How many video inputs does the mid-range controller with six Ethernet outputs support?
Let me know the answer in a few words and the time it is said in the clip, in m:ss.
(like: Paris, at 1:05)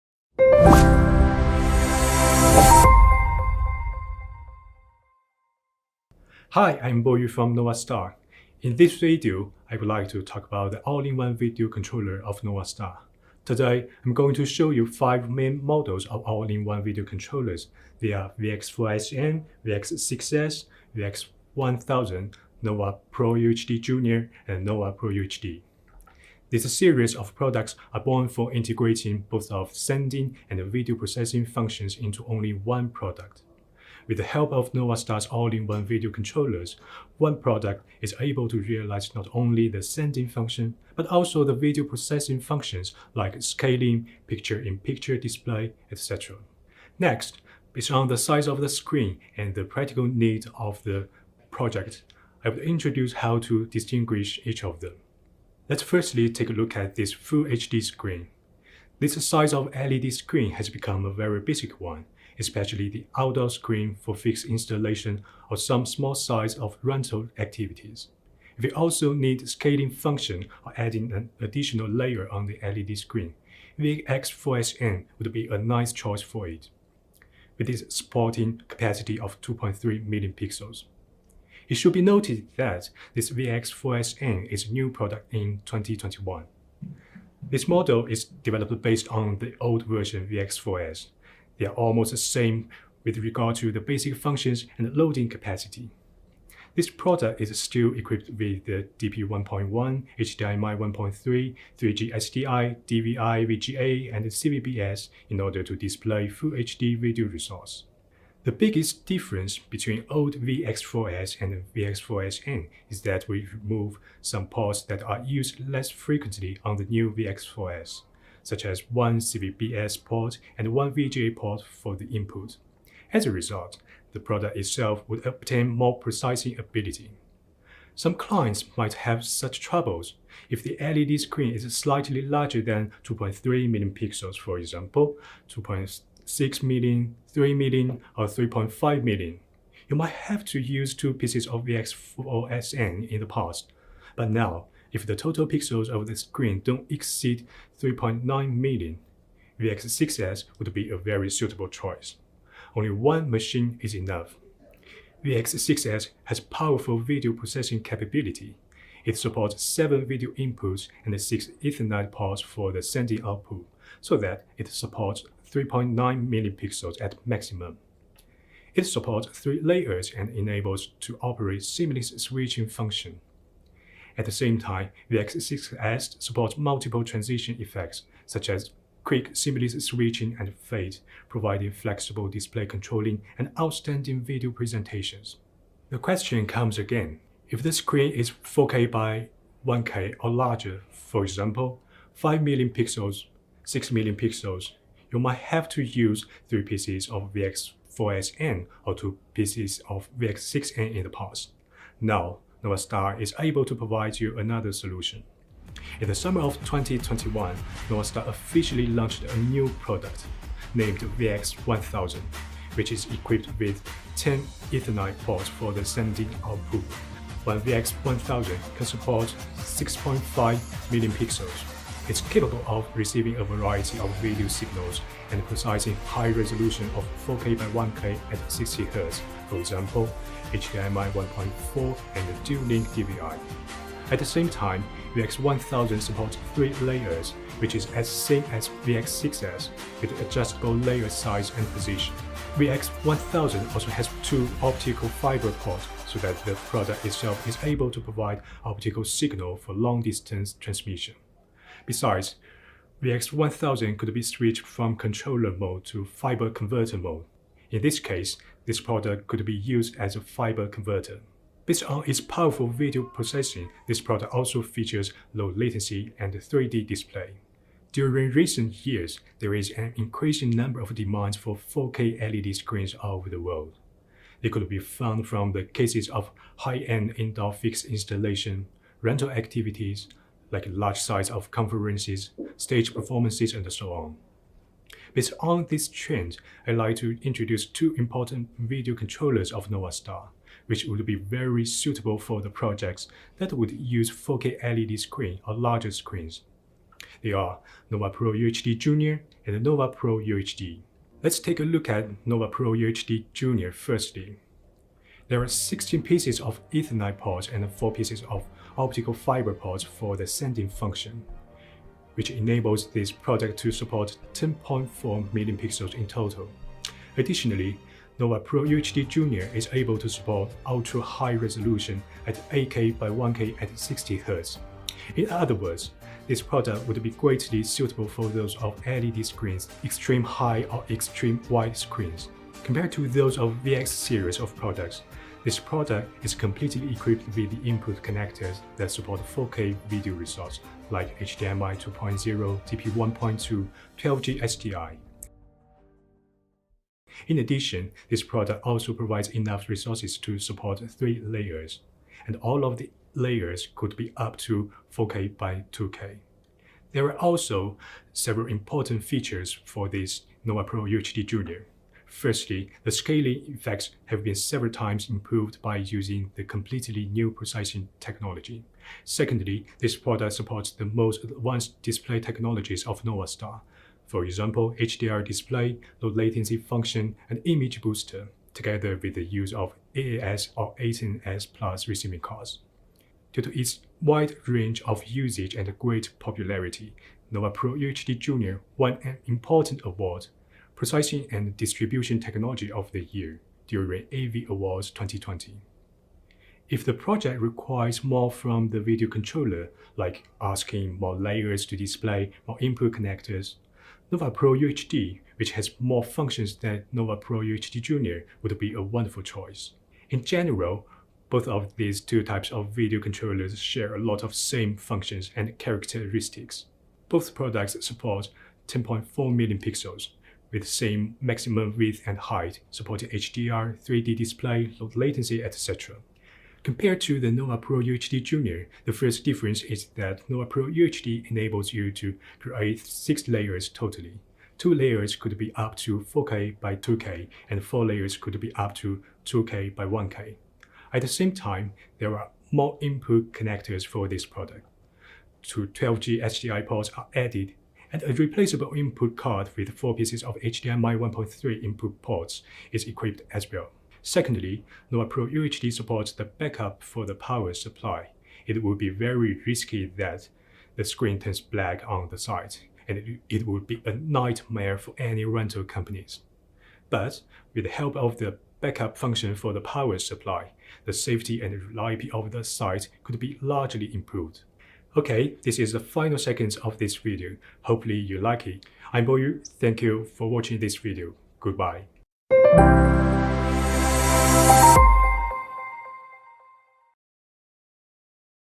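7, at 2:39.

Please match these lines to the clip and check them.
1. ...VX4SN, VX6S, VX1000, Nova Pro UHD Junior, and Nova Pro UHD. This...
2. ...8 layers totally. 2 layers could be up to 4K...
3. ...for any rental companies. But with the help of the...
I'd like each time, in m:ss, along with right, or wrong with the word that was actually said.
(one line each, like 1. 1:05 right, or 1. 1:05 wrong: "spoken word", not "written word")
1. 0:18 right
2. 7:12 wrong: "6", not "8"
3. 7:44 right.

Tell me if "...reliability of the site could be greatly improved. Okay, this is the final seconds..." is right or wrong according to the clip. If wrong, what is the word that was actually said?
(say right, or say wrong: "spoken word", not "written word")
wrong: "largely", not "greatly".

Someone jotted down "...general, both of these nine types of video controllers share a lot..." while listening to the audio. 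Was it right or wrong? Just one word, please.
wrong.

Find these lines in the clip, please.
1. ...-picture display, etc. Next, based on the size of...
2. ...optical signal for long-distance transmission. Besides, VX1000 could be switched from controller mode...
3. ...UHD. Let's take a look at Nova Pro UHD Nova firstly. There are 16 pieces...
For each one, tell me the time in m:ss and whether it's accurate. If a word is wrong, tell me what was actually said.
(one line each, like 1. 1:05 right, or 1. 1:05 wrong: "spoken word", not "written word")
1. 0:45 right
2. 4:08 right
3. 5:00 wrong: "Junior", not "Nova".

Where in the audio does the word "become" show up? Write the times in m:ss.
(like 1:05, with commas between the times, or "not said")
1:00.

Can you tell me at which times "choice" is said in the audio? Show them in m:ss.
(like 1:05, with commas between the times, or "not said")
1:15, 2:31, 6:49.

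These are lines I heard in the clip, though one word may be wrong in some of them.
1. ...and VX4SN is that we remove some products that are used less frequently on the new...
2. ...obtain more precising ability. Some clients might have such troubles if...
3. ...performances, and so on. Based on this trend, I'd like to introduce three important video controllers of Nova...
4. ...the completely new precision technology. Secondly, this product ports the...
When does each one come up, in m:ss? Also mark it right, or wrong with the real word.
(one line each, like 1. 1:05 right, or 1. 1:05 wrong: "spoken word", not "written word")
1. 1:51 wrong: "ports", not "products"
2. 2:05 right
3. 4:42 wrong: "two", not "three"
4. 6:06 wrong: "supports", not "ports".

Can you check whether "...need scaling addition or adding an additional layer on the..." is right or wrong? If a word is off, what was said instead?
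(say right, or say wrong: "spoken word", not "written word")
wrong: "function", not "addition".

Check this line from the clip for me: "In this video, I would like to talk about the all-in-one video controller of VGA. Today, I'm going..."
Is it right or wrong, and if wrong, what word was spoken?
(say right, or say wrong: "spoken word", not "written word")
wrong: "NovaStar", not "VGA".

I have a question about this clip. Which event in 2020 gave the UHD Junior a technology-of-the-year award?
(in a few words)
AV Awards.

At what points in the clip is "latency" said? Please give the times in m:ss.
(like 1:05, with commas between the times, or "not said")
4:25, 6:16, 7:04.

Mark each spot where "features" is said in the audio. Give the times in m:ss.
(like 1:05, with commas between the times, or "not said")
4:24, 5:59.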